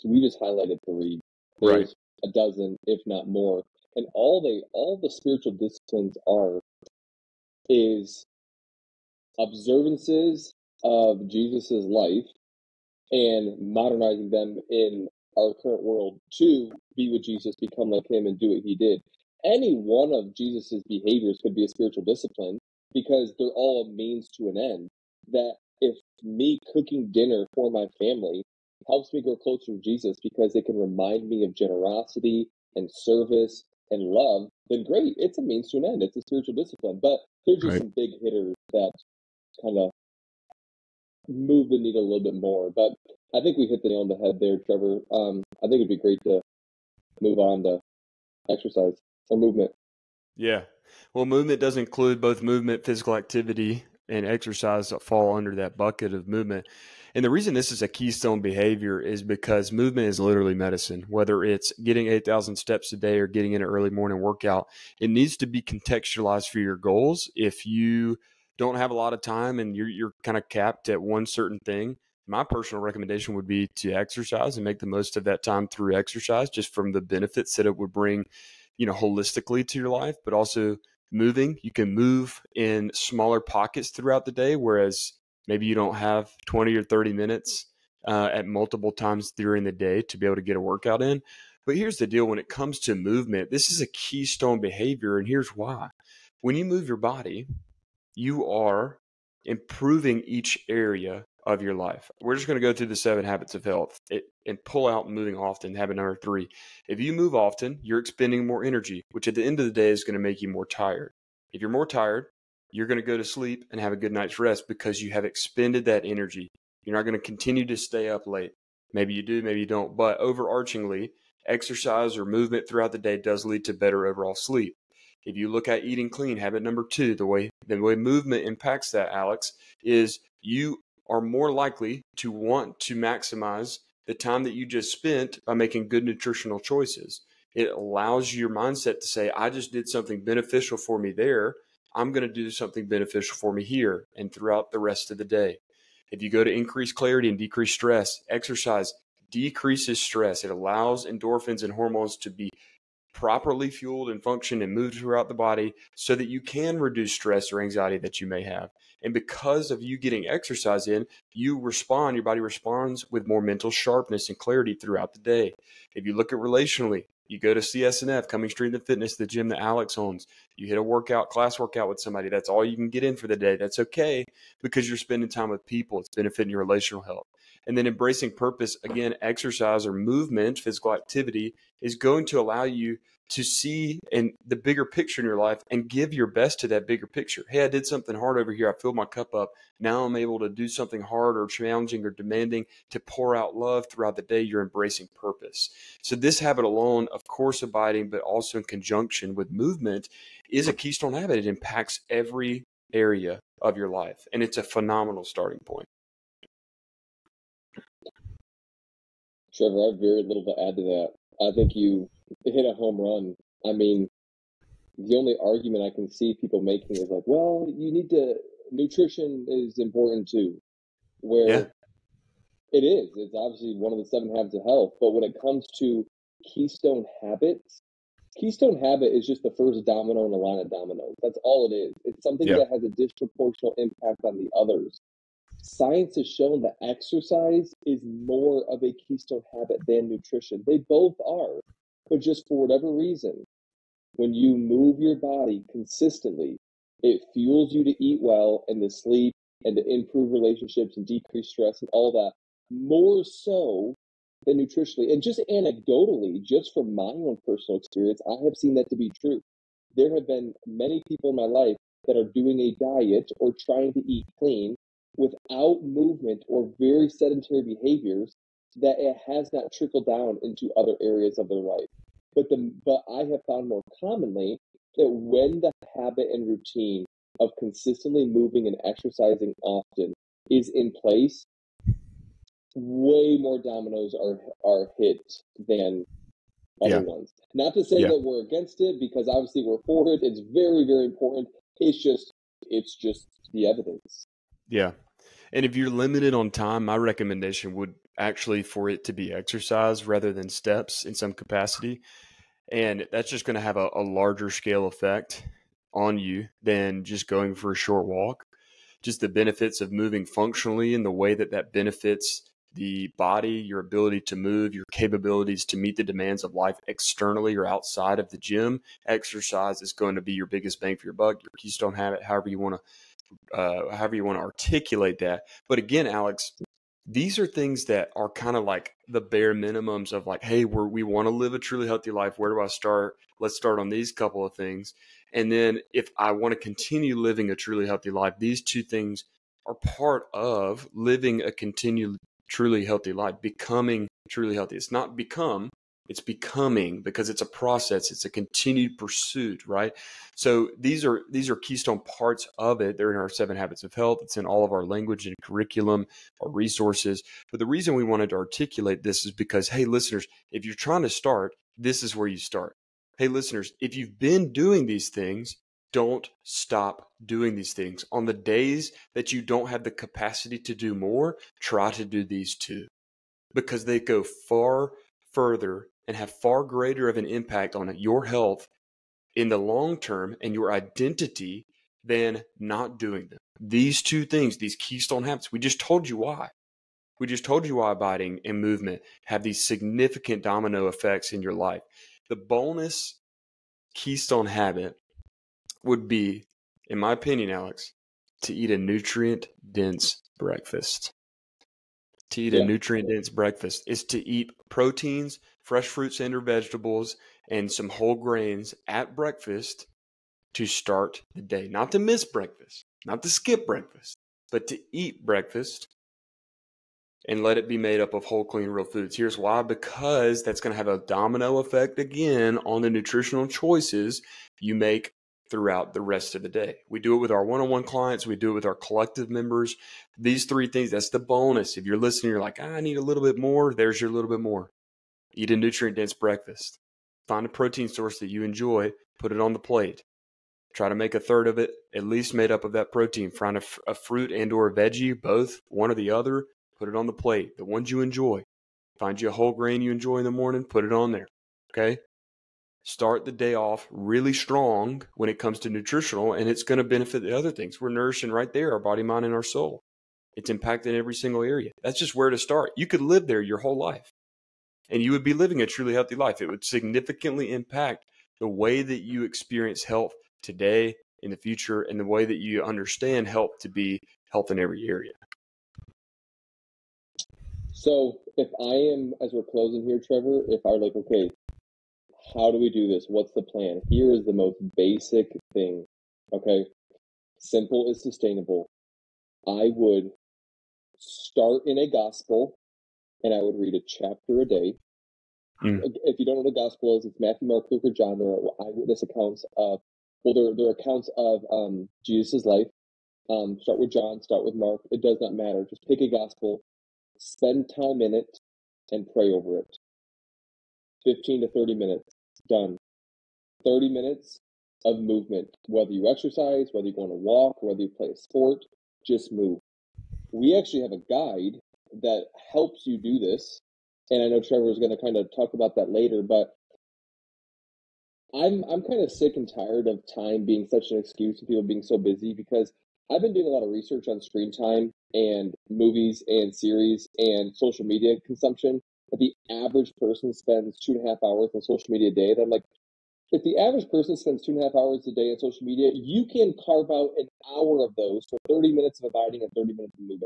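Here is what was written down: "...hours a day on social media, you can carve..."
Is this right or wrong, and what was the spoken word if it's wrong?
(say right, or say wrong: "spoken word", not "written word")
right.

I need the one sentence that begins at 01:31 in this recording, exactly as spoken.
But here's the deal when it comes to movement, this is a keystone behavior, and here's why.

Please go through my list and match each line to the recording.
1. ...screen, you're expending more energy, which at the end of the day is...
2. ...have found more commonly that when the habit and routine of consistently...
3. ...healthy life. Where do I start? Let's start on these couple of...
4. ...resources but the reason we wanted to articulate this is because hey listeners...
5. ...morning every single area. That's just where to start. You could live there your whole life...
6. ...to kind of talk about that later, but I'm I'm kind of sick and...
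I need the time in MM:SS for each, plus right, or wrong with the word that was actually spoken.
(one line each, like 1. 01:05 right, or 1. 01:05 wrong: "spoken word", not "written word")
1. 01:47 wrong: "often", not "screen"
2. 04:33 right
3. 05:31 right
4. 05:56 right
5. 07:40 wrong: "impacting", not "morning"
6. 08:44 right.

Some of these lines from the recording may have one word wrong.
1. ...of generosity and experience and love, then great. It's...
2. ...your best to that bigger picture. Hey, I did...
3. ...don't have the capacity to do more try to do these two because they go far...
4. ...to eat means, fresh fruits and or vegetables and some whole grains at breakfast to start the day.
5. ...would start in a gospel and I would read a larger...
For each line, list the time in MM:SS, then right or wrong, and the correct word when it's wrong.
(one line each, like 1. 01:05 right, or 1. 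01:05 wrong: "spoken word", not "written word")
1. 00:31 wrong: "service", not "experience"
2. 03:06 right
3. 06:09 right
4. 06:44 wrong: "proteins", not "means"
5. 08:09 wrong: "chapter", not "larger".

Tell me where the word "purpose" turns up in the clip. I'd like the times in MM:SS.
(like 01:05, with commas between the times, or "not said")
02:58, 03:15.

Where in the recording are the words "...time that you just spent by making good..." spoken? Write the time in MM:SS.
02:14.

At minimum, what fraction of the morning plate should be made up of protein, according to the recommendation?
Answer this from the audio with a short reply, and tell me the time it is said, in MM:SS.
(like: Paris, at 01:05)
A third, at 07:21.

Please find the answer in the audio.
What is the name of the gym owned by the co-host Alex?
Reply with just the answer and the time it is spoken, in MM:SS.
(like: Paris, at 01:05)
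Coming Straight to Fitness, at 02:48.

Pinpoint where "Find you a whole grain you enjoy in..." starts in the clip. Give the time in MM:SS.
07:28.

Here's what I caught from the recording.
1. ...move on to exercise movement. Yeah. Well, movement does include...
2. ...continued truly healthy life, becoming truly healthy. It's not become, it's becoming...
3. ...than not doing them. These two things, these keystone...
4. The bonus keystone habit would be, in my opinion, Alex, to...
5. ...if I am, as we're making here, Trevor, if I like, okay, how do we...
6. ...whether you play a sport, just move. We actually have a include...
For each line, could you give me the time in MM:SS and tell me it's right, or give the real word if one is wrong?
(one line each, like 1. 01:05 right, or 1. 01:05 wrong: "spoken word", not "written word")
1. 00:47 right
2. 05:41 right
3. 06:22 right
4. 06:32 right
5. 07:58 wrong: "closing", not "making"
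6. 08:37 wrong: "guide", not "include".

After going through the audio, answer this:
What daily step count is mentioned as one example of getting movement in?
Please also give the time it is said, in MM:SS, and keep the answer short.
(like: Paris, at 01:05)
8,000, at 01:02.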